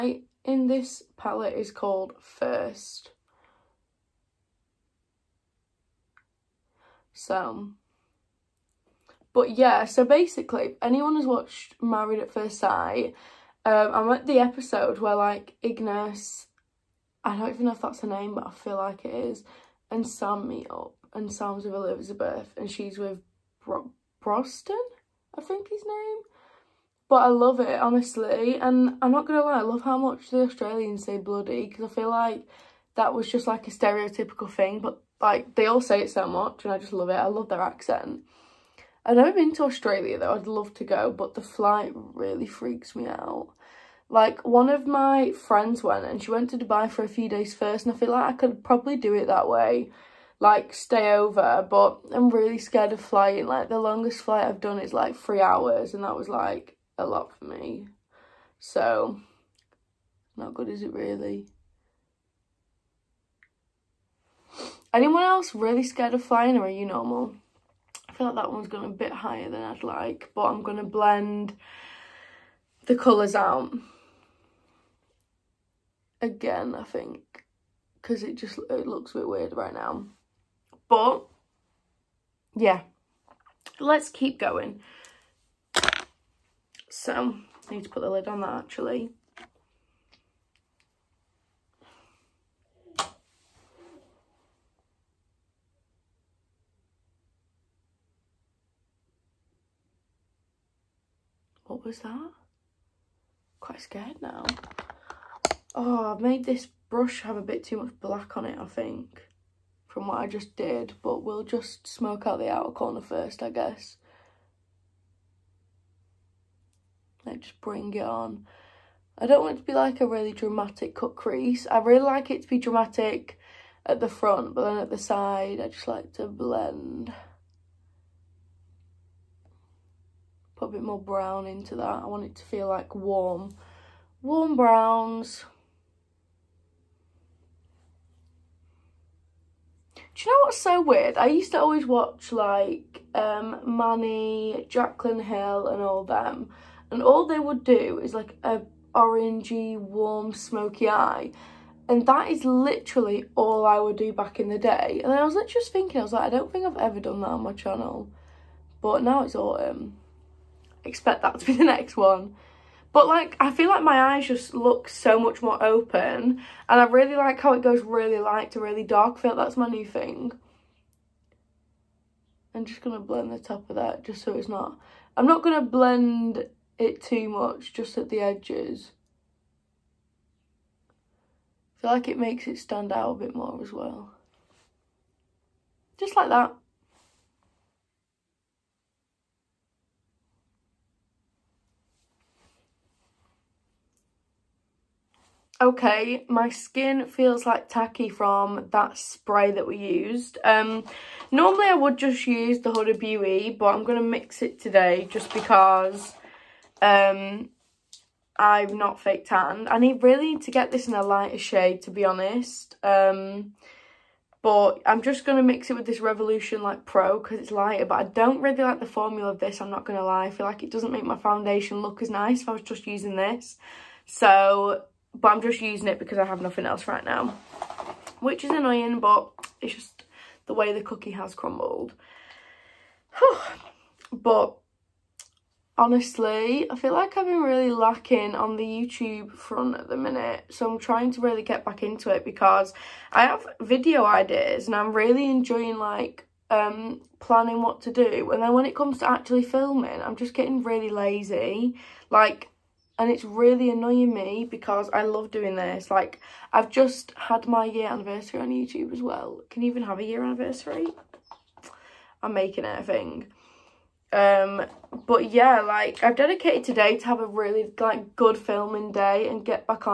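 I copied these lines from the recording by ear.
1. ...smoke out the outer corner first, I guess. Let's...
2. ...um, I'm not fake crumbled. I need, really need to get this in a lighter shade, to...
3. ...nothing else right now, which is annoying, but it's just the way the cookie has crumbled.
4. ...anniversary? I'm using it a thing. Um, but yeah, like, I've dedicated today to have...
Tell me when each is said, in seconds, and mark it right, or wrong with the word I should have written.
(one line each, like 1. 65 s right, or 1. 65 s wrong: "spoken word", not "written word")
1. 111 s right
2. 206 s wrong: "tanned", not "crumbled"
3. 226 s right
4. 260 s wrong: "making", not "using".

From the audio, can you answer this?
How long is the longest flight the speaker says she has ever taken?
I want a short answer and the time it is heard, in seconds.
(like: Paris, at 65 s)
3 hours, at 55 s.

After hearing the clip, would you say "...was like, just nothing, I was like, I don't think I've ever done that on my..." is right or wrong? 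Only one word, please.
wrong.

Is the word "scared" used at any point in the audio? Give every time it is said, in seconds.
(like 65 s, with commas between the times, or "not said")
52 s, 65 s, 103 s.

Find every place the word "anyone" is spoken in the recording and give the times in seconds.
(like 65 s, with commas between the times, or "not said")
10 s, 64 s.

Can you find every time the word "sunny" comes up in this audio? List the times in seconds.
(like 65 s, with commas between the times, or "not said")
not said.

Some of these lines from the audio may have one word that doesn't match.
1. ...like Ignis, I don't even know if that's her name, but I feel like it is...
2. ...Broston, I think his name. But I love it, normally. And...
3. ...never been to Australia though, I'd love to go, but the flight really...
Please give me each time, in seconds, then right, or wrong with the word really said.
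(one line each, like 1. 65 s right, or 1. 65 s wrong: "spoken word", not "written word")
1. 15 s right
2. 24 s wrong: "honestly", not "normally"
3. 39 s right.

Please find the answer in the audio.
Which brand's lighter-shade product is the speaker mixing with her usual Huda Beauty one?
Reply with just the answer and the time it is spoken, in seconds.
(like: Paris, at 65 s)
Revolution, at 216 s.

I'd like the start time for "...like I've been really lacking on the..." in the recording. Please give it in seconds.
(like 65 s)
236 s.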